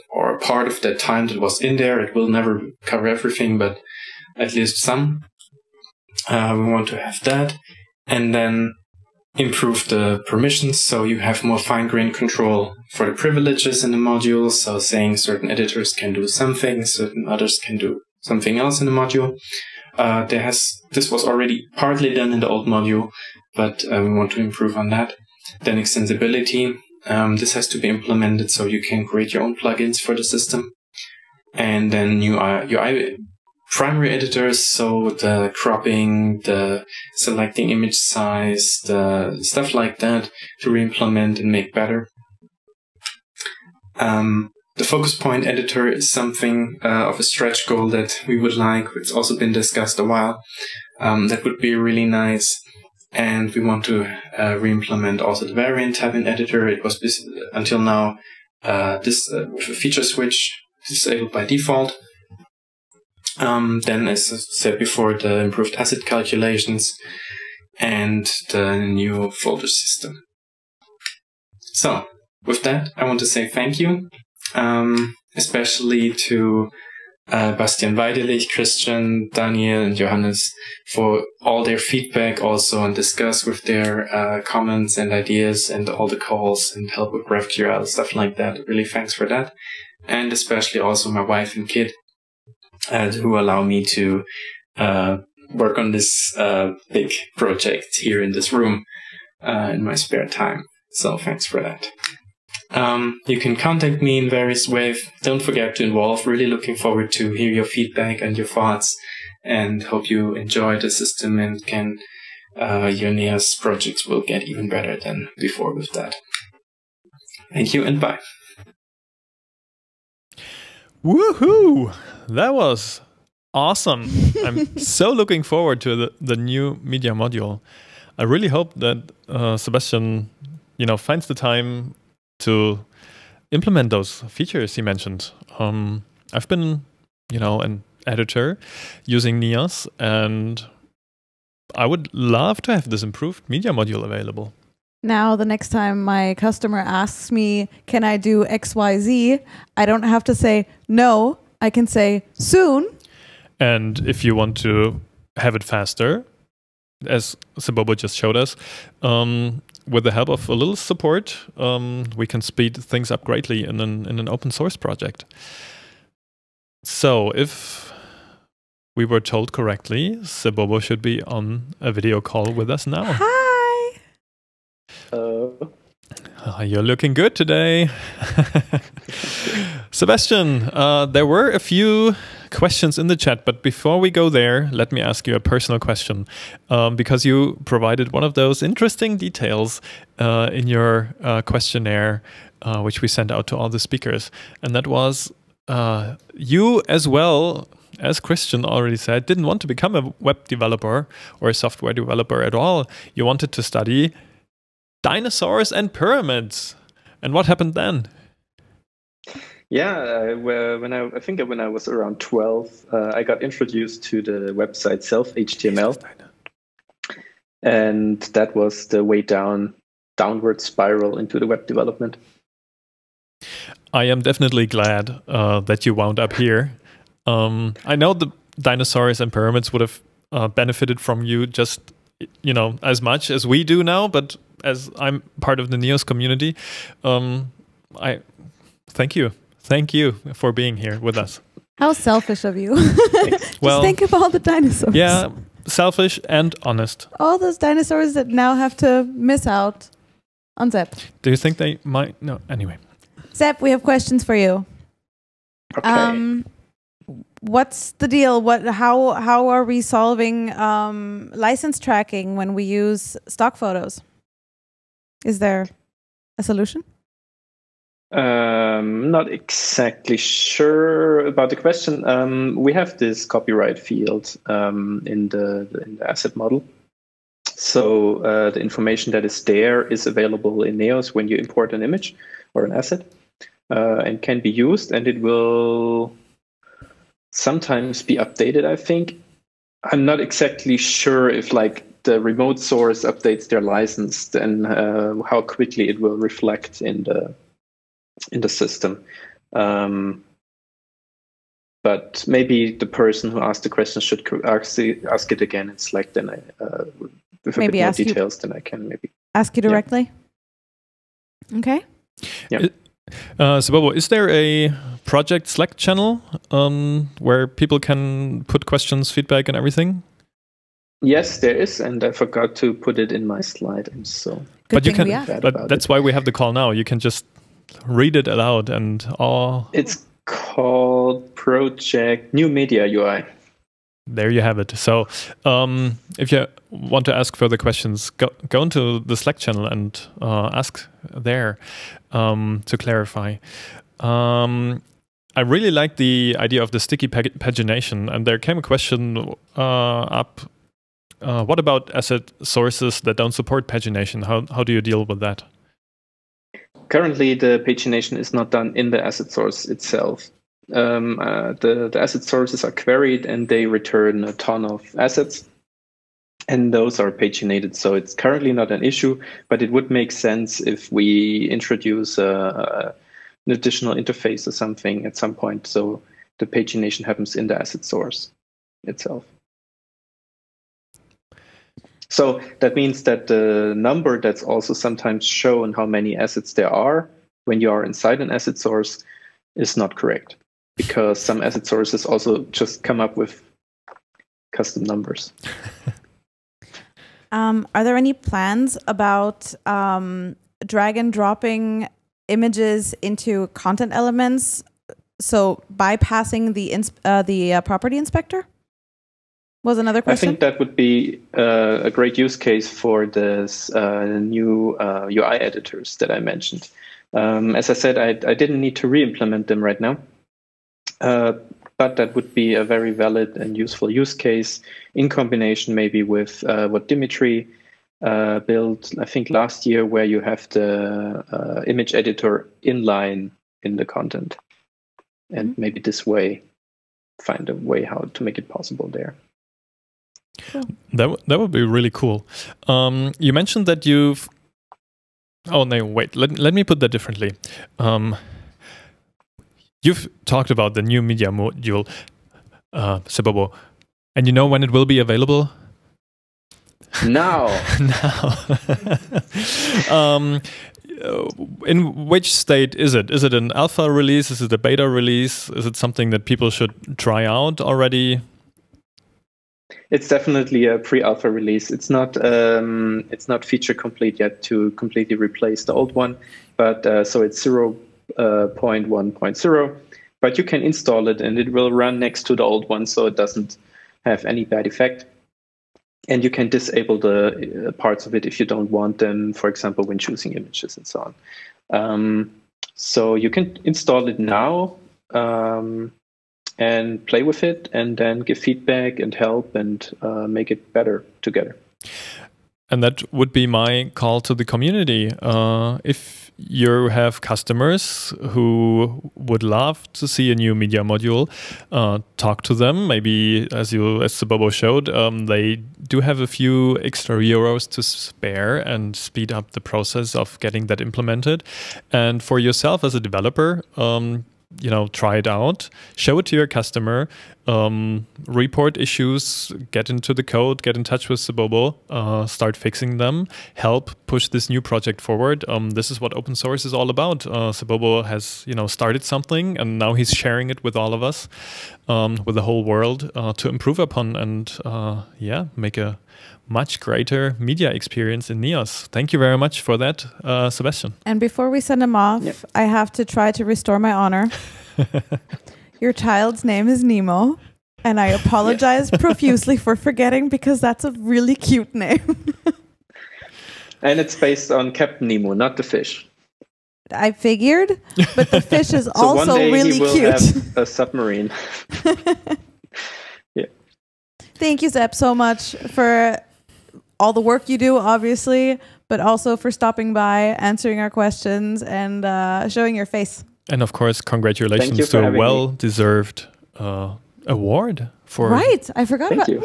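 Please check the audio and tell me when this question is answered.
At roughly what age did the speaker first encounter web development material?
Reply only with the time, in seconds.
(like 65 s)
212 s.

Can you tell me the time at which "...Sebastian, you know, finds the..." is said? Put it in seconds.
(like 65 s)
129 s.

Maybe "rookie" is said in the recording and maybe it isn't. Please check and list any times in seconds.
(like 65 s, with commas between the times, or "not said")
not said.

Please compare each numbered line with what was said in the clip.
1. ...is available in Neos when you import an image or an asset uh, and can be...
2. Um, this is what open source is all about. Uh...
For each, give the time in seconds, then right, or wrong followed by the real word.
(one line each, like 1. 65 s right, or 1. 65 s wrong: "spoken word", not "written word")
1. 279 s right
2. 535 s right.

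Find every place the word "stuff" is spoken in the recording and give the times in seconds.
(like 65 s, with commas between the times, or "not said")
39 s, 87 s.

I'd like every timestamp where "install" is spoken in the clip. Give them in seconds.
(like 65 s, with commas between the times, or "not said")
480 s, 493 s.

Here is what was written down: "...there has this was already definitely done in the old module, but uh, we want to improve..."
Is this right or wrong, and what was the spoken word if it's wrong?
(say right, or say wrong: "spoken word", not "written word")
wrong: "partly", not "definitely".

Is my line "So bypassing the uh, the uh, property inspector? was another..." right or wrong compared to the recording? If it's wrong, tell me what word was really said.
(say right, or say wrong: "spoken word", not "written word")
right.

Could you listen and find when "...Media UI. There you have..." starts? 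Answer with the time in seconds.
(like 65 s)
332 s.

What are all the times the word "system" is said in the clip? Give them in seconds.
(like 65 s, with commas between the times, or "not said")
30 s, 69 s, 110 s, 298 s.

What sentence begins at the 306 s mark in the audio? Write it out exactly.
Then I, uh, with a maybe bit more details, you, then I can maybe ask you directly.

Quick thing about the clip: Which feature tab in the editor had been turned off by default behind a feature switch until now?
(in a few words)
Variant tab.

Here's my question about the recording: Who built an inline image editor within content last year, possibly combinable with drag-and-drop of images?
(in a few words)
Dimitri.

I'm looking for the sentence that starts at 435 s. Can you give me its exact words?
maybe this way find a way how to make it possible there.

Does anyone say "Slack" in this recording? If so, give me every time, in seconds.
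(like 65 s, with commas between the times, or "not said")
305 s, 315 s, 339 s.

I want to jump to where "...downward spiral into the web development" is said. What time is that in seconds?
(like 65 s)
220 s.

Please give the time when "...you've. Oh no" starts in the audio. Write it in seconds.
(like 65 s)
443 s.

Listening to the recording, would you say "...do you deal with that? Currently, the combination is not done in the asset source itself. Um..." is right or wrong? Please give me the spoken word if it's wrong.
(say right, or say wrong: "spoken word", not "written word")
wrong: "pagination", not "combination".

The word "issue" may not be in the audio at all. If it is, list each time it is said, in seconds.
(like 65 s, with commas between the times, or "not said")
368 s, 528 s.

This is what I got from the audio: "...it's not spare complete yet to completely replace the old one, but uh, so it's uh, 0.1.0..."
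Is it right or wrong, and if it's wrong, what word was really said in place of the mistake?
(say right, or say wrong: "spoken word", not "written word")
wrong: "feature", not "spare".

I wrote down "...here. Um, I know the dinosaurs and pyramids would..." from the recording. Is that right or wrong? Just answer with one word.
right.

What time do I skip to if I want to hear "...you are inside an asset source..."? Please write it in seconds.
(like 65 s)
387 s.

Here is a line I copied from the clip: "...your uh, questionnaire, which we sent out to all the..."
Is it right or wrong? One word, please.
right.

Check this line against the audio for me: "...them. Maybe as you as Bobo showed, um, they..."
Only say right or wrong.
right.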